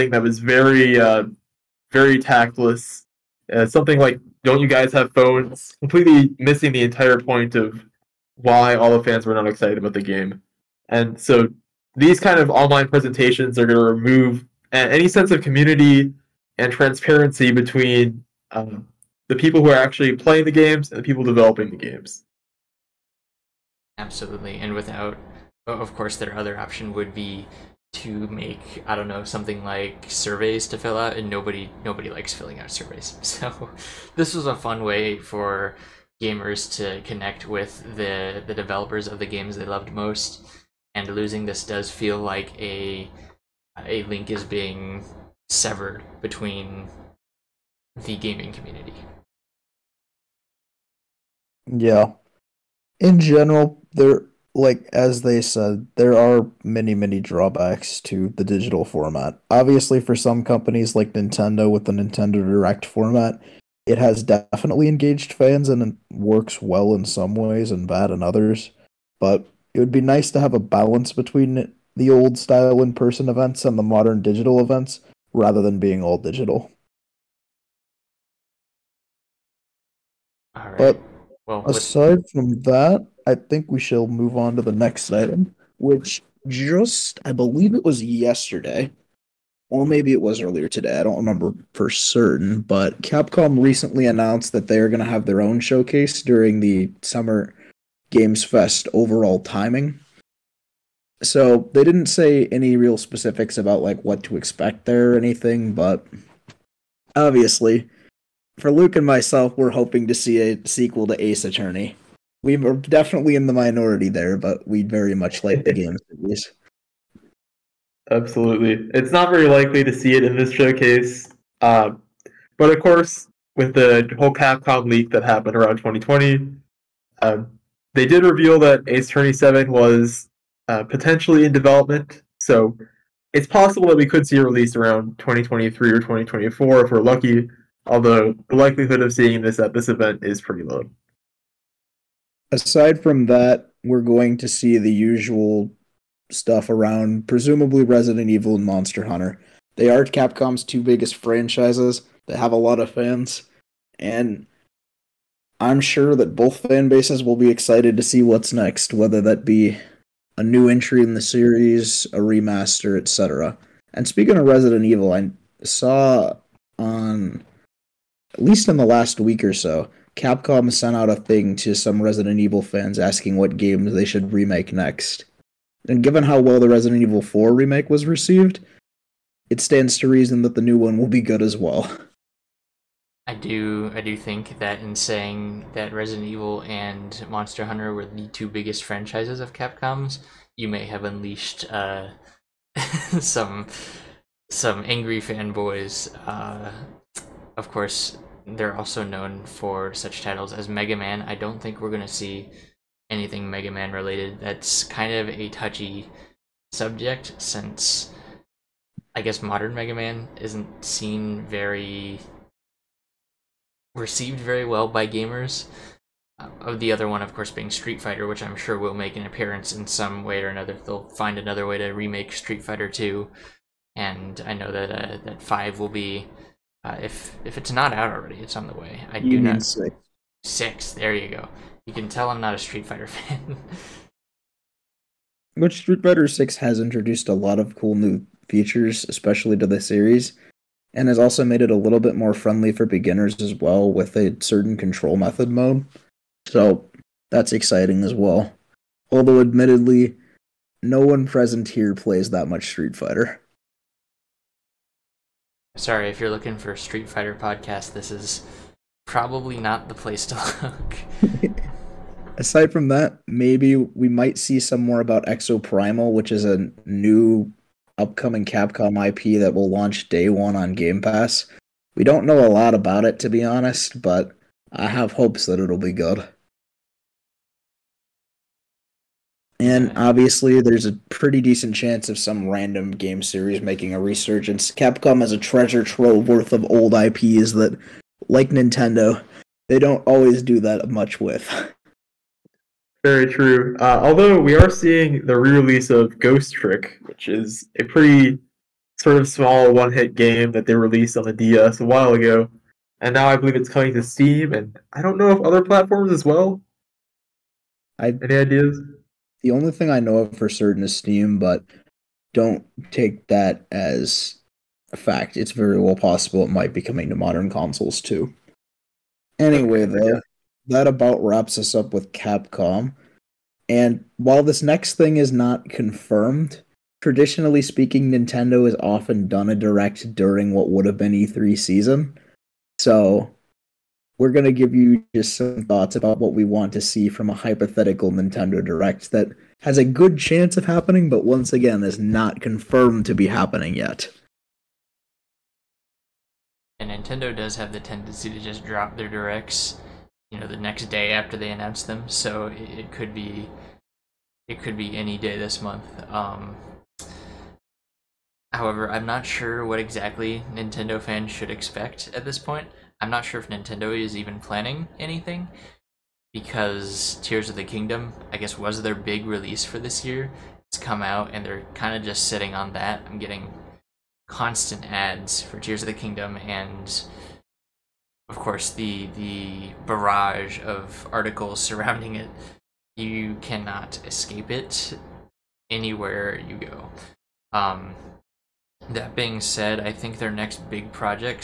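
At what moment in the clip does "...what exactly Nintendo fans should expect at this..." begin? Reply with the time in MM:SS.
05:59.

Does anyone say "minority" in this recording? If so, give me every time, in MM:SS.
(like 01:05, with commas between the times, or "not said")
01:53.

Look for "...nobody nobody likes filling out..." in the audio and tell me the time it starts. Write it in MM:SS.
00:31.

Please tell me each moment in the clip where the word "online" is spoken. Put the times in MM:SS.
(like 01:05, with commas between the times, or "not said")
00:12.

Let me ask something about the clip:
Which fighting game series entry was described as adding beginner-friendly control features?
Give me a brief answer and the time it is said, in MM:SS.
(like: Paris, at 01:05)
Street Fighter Six, at 03:55.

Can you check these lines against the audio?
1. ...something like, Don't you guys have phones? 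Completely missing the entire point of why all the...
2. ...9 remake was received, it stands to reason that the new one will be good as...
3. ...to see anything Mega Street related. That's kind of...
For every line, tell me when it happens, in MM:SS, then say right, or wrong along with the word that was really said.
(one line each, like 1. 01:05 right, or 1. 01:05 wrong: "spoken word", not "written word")
1. 00:03 right
2. 02:57 wrong: "4", not "9"
3. 03:22 wrong: "Man", not "Street".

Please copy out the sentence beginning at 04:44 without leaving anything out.
Capcom has a treasure trove worth of old IPs that, like Nintendo, they don't always do that much with.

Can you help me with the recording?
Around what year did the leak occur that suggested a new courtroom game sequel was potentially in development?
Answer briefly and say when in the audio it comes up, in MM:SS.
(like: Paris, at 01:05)
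2020, at 02:05.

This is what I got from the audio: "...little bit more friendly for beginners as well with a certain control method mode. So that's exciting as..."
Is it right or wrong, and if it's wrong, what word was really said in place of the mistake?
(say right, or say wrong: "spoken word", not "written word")
right.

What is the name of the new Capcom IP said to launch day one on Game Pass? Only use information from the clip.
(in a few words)
Exoprimal.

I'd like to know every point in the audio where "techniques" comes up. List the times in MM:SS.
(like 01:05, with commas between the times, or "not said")
not said.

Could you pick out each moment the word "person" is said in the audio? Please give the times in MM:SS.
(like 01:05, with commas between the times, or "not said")
01:12.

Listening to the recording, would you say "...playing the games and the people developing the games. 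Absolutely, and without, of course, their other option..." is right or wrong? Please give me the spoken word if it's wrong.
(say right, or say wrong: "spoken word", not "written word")
right.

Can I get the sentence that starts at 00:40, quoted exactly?
And losing this does feel like a a link is being severed between the gaming community.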